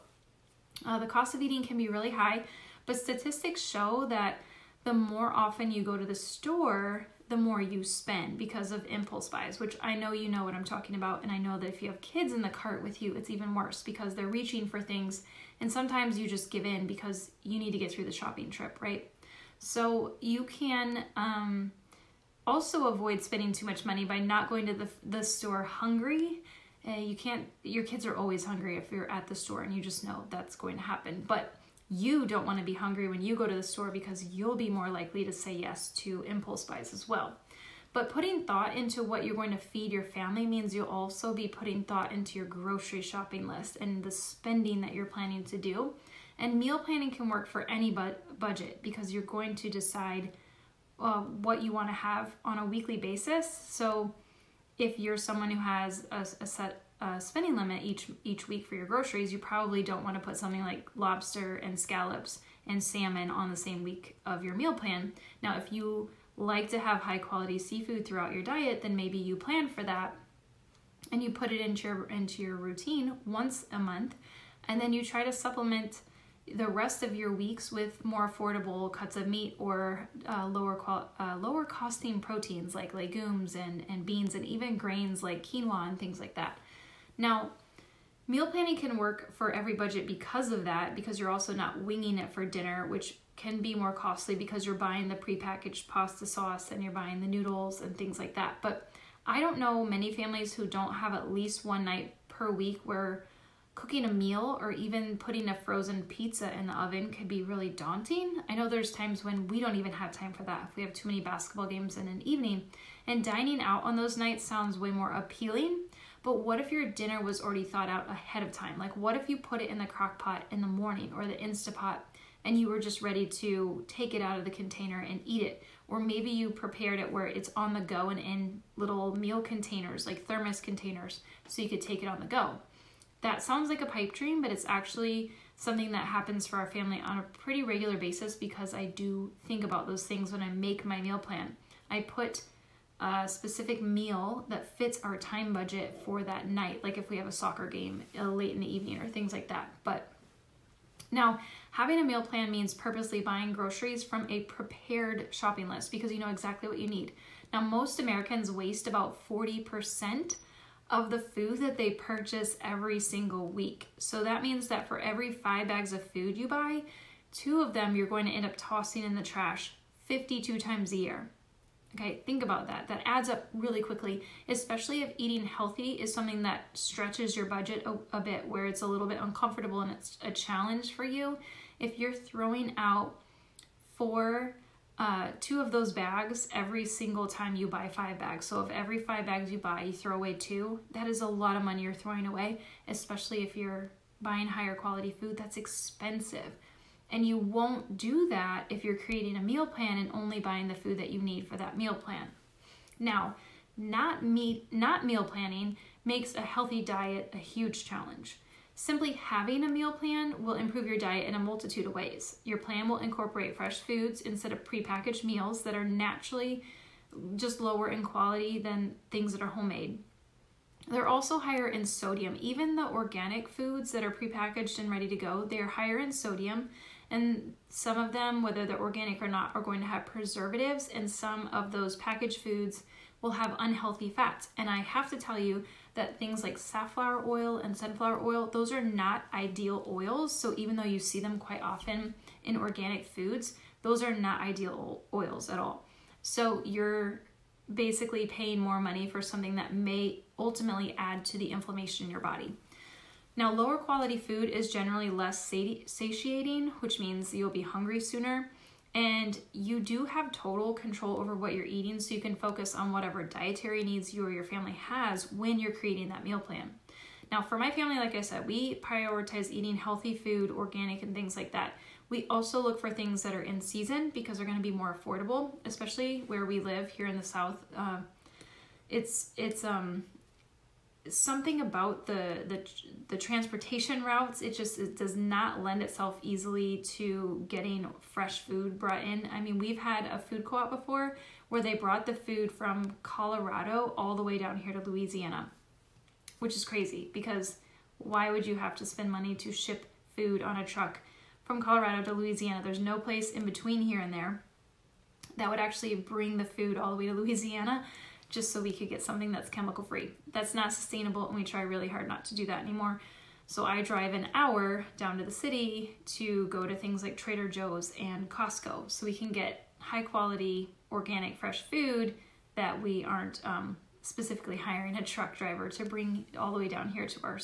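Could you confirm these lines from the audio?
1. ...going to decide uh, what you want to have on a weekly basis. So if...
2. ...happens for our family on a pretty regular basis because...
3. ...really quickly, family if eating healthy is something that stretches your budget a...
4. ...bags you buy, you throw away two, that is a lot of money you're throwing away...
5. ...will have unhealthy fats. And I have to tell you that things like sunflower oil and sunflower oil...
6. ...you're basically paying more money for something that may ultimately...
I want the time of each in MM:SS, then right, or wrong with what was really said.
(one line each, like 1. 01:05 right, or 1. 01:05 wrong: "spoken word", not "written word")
1. 00:49 right
2. 02:16 right
3. 02:53 wrong: "especially", not "family"
4. 03:09 right
5. 03:53 wrong: "safflower", not "sunflower"
6. 04:06 right.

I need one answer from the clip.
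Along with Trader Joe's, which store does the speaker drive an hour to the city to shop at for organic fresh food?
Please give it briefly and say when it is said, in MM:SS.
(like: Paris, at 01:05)
Costco, at 05:18.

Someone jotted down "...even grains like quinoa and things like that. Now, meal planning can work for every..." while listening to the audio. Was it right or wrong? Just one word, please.
right.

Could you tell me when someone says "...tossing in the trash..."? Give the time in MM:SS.
02:48.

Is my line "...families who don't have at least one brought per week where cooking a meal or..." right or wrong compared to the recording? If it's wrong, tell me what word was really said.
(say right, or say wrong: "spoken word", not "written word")
wrong: "night", not "brought".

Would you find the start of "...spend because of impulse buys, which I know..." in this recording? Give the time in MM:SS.
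00:07.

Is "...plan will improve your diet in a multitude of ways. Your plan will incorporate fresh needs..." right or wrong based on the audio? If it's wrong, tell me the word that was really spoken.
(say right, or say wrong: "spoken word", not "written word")
wrong: "foods", not "needs".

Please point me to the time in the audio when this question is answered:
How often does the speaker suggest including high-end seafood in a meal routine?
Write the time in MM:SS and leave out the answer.
01:13.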